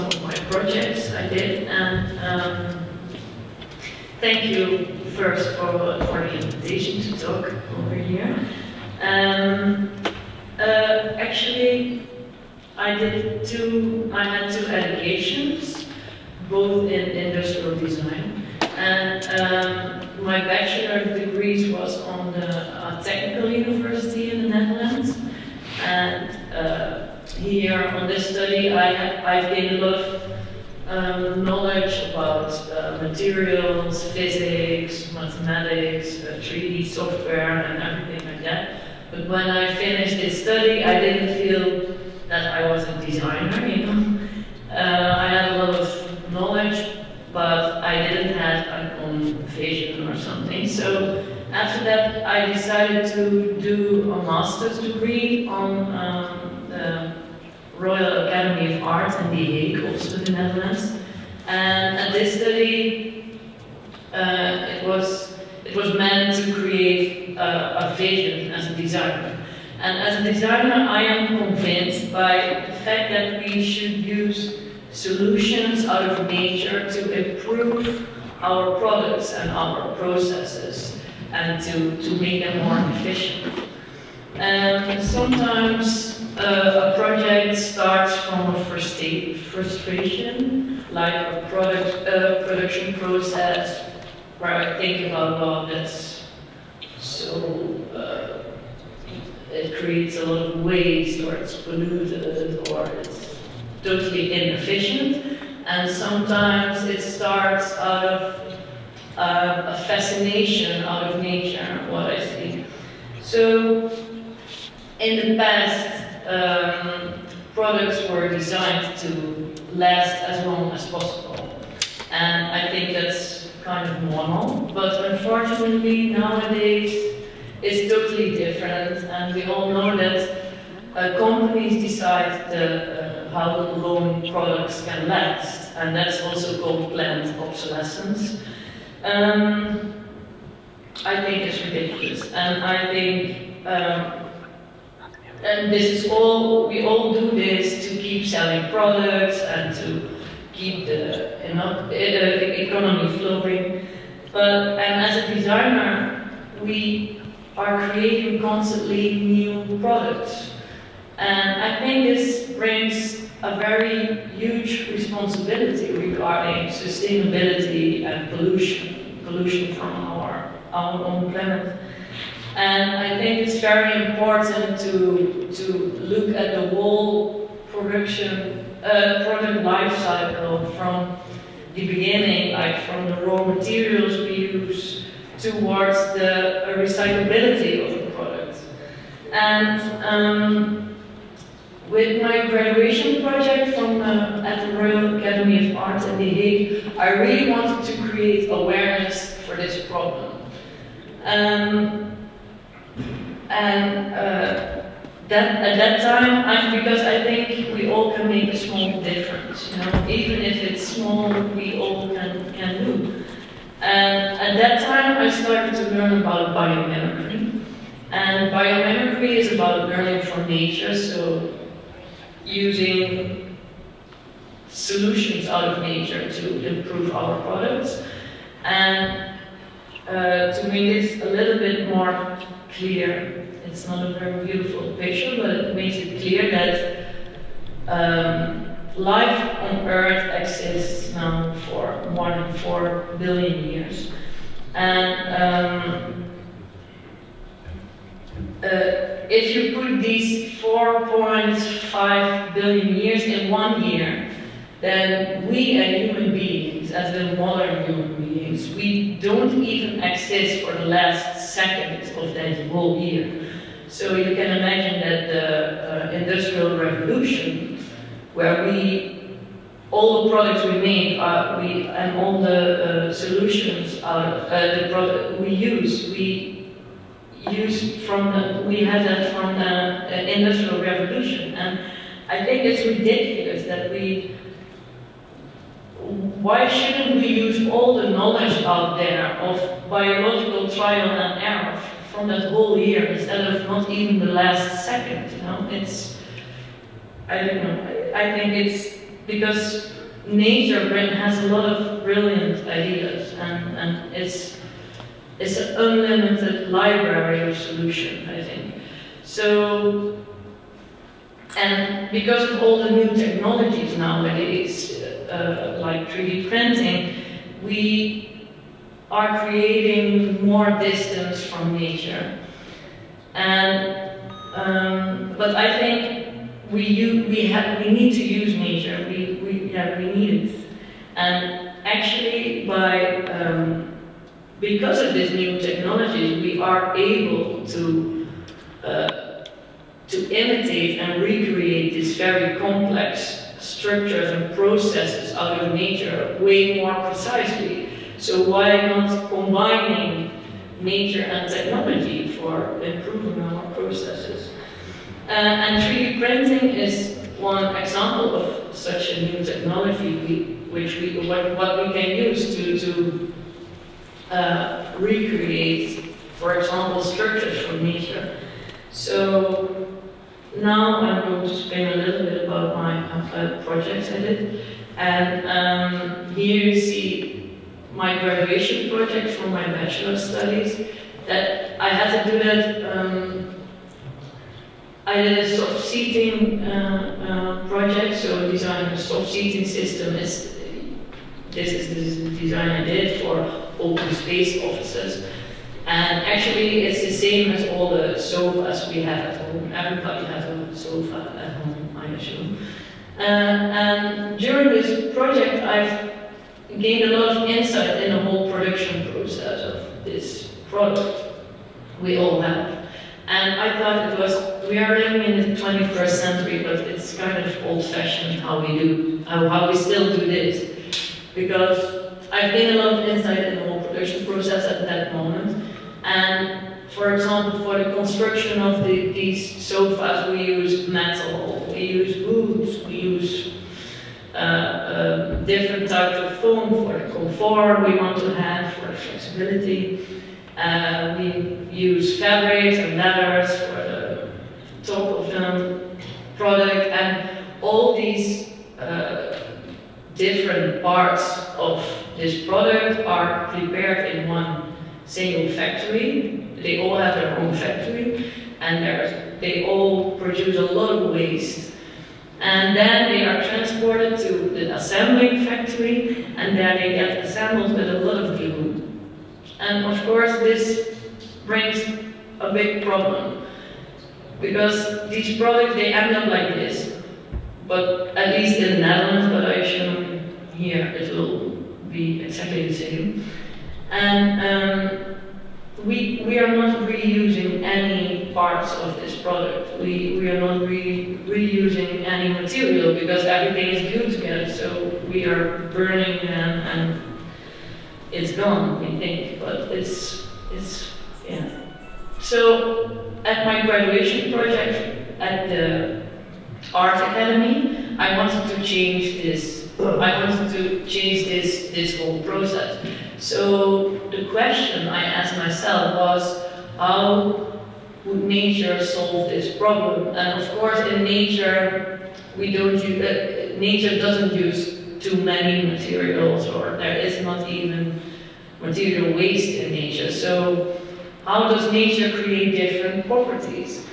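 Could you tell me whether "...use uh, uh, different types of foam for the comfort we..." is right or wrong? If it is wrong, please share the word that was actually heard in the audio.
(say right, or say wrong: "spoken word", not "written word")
right.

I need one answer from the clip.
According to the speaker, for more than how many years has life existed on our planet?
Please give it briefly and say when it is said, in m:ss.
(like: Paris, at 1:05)
4 billion years, at 4:02.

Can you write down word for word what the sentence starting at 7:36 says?
They all have their own factory and they all produce a lot of waste.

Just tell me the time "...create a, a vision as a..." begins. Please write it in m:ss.
1:06.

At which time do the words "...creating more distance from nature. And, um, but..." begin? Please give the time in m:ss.
5:19.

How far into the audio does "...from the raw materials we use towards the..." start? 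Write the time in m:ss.
3:02.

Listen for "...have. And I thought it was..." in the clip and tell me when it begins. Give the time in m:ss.
6:52.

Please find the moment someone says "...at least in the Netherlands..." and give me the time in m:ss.
7:58.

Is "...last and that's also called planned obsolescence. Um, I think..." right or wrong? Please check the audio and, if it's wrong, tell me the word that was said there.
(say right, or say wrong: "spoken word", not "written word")
right.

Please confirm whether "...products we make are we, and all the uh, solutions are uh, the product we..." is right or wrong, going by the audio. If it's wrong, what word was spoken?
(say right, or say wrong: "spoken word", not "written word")
right.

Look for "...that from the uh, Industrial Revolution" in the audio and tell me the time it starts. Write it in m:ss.
4:39.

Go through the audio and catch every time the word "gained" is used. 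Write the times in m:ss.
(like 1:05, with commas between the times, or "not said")
0:29, 6:46, 7:02.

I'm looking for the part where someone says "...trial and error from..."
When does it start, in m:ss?
4:50.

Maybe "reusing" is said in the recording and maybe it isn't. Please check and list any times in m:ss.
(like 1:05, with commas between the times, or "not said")
8:06, 8:11.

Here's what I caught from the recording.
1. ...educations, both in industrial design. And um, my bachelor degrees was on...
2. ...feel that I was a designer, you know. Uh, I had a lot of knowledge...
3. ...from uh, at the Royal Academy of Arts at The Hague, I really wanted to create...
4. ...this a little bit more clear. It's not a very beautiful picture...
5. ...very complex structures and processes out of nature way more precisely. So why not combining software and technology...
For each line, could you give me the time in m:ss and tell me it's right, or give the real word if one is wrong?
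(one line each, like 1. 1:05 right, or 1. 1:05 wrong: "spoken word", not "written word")
1. 0:14 right
2. 0:41 right
3. 3:13 right
4. 3:51 right
5. 5:42 wrong: "nature", not "software".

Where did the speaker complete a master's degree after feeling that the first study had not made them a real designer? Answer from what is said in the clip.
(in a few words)
Royal Academy of Art.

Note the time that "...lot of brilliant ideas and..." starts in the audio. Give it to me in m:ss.
5:01.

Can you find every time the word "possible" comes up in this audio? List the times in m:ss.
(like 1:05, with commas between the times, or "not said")
2:00.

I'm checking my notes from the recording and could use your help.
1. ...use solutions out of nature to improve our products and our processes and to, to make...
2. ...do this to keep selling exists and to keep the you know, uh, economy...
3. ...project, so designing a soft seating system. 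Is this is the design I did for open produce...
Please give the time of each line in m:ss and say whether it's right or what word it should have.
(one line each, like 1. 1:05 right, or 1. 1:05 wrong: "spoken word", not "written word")
1. 1:14 right
2. 2:27 wrong: "products", not "exists"
3. 6:27 wrong: "space", not "produce".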